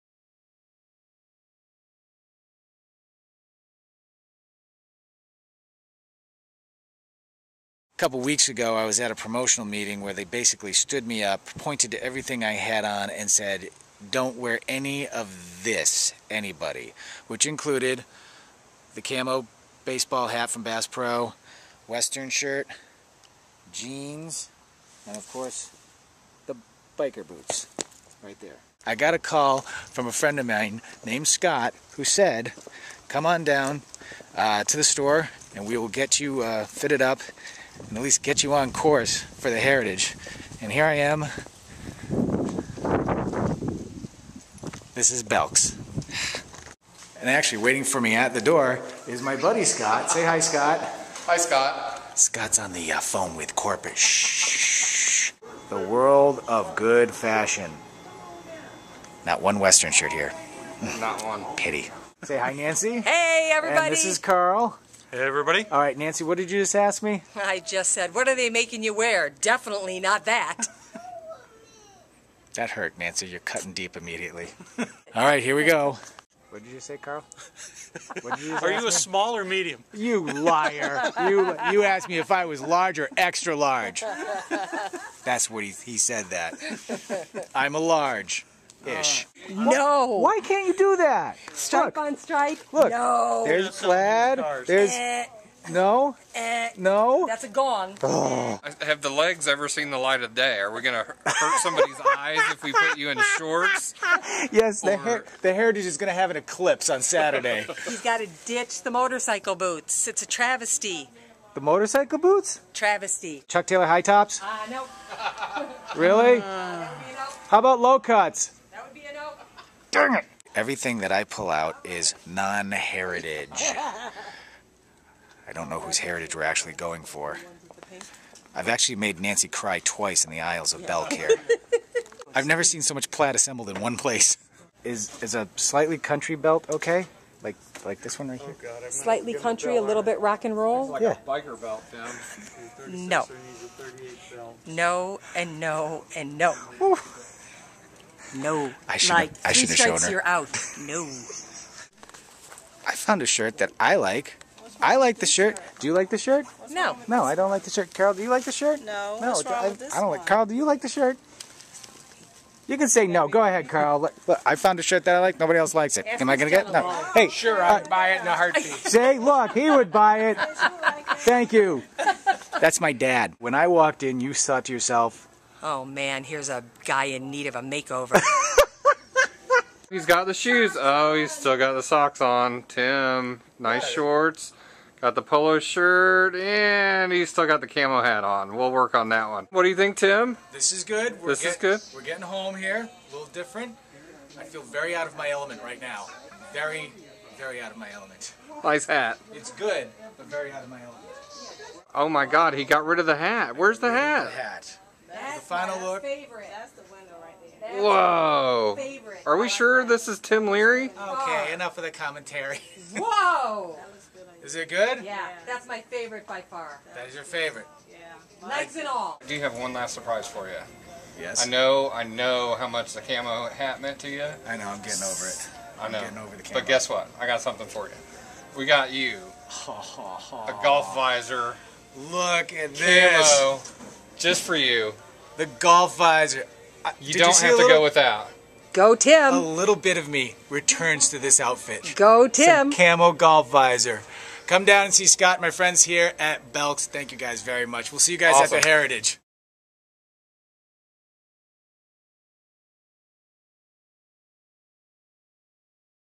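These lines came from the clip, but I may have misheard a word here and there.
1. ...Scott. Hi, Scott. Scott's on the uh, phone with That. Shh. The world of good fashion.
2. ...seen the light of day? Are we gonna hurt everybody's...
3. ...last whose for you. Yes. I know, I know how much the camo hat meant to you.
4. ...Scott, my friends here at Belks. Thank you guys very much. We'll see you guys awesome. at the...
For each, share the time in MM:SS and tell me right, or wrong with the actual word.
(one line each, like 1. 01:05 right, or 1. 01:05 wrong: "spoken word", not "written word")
1. 00:50 wrong: "Corpus", not "That"
2. 01:39 wrong: "somebody", not "everybody"
3. 03:39 wrong: "surprise", not "whose"
4. 04:05 right.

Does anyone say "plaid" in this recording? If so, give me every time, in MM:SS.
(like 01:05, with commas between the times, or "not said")
01:33, 02:13.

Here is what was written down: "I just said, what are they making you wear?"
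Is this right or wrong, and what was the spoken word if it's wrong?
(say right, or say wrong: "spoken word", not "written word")
right.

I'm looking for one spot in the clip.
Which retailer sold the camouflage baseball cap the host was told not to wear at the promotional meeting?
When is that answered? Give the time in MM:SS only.
00:20.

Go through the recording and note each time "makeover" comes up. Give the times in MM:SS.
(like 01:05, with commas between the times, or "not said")
02:57.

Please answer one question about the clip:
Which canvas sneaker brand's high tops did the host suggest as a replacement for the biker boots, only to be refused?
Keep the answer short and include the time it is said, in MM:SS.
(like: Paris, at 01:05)
Chuck Taylor, at 01:53.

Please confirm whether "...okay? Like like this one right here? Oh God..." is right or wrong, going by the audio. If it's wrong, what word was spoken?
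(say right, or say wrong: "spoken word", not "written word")
right.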